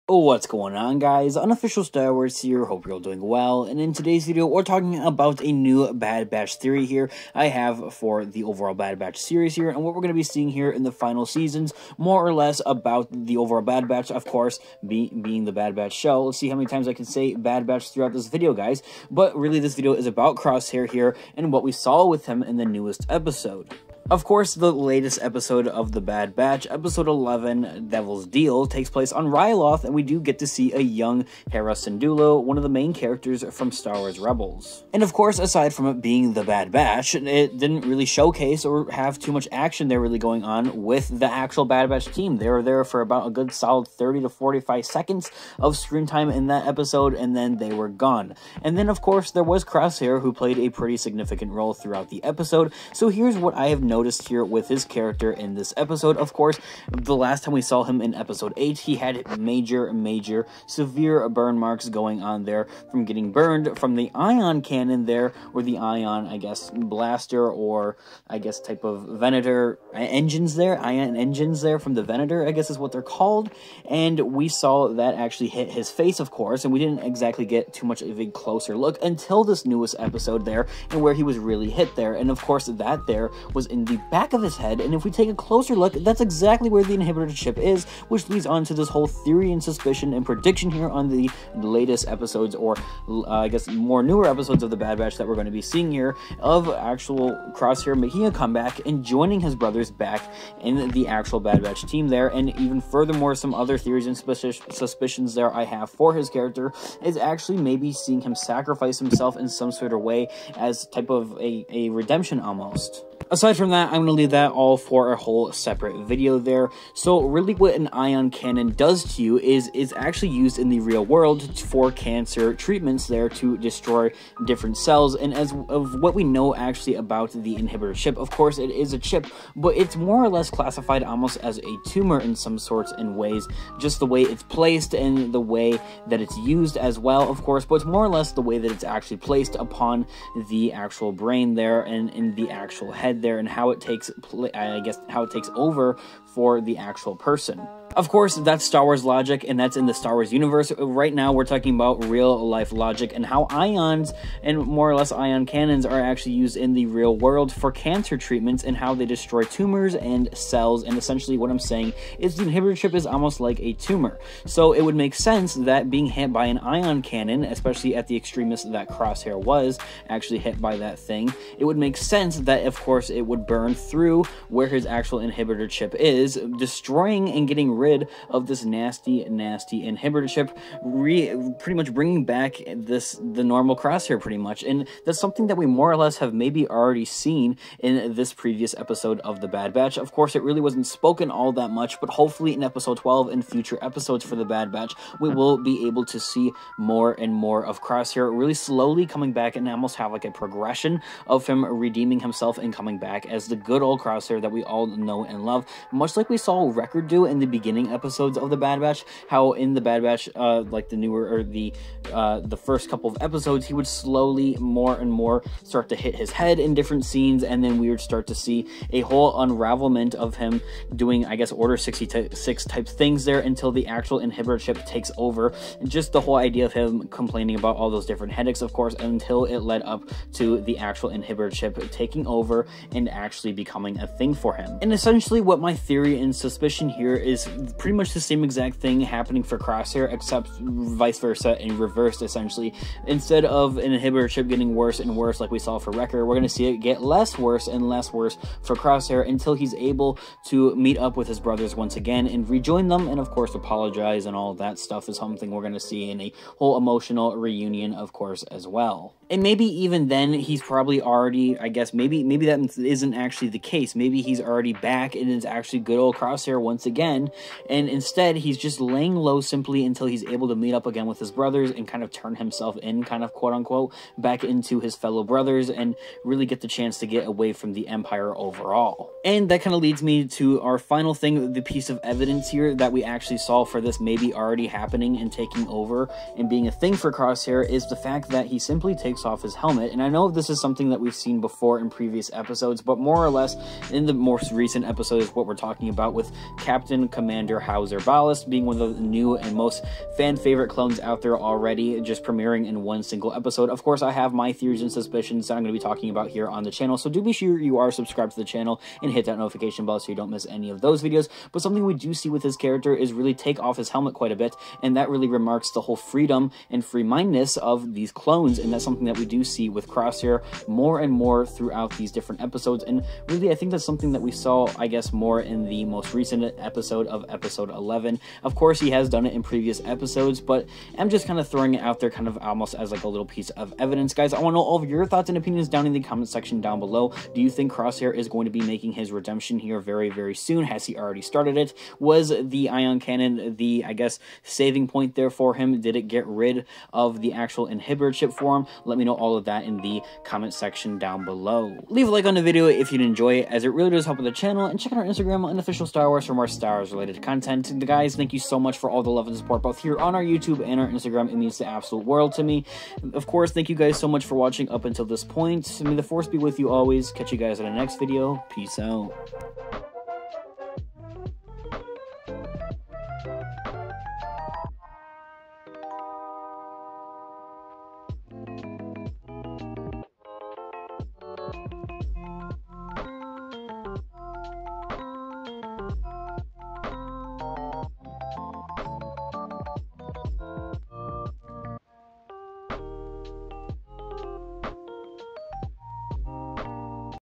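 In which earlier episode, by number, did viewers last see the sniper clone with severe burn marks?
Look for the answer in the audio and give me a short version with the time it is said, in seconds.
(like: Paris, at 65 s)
8, at 58 s.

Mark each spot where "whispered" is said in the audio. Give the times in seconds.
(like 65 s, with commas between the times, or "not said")
not said.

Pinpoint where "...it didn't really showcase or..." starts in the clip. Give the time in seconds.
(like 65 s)
37 s.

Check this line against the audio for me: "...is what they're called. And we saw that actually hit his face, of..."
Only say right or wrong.
right.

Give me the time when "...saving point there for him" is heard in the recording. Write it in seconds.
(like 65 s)
344 s.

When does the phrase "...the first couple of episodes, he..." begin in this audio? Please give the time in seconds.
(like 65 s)
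212 s.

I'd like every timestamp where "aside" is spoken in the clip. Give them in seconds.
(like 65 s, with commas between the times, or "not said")
35 s, 113 s.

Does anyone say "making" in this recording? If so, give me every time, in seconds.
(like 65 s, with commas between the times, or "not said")
97 s, 338 s.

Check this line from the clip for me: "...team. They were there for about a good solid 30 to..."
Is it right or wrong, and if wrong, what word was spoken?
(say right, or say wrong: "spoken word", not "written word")
right.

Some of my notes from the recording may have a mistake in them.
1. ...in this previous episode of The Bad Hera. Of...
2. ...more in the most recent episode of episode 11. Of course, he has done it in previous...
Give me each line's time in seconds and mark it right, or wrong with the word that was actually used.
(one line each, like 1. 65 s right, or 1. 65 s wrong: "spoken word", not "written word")
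1. 187 s wrong: "Batch", not "Hera"
2. 325 s right.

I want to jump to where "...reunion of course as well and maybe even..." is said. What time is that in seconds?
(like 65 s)
257 s.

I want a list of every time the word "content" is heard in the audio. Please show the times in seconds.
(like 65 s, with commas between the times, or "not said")
357 s.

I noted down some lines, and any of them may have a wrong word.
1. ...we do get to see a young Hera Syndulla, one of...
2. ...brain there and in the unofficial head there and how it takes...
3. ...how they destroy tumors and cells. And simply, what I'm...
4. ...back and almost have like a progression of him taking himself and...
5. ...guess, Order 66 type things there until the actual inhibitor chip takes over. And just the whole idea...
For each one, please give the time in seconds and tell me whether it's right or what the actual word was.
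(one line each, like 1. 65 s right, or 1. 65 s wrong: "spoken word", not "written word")
1. 29 s right
2. 141 s wrong: "actual", not "unofficial"
3. 158 s wrong: "essentially", not "simply"
4. 199 s wrong: "redeeming", not "taking"
5. 221 s right.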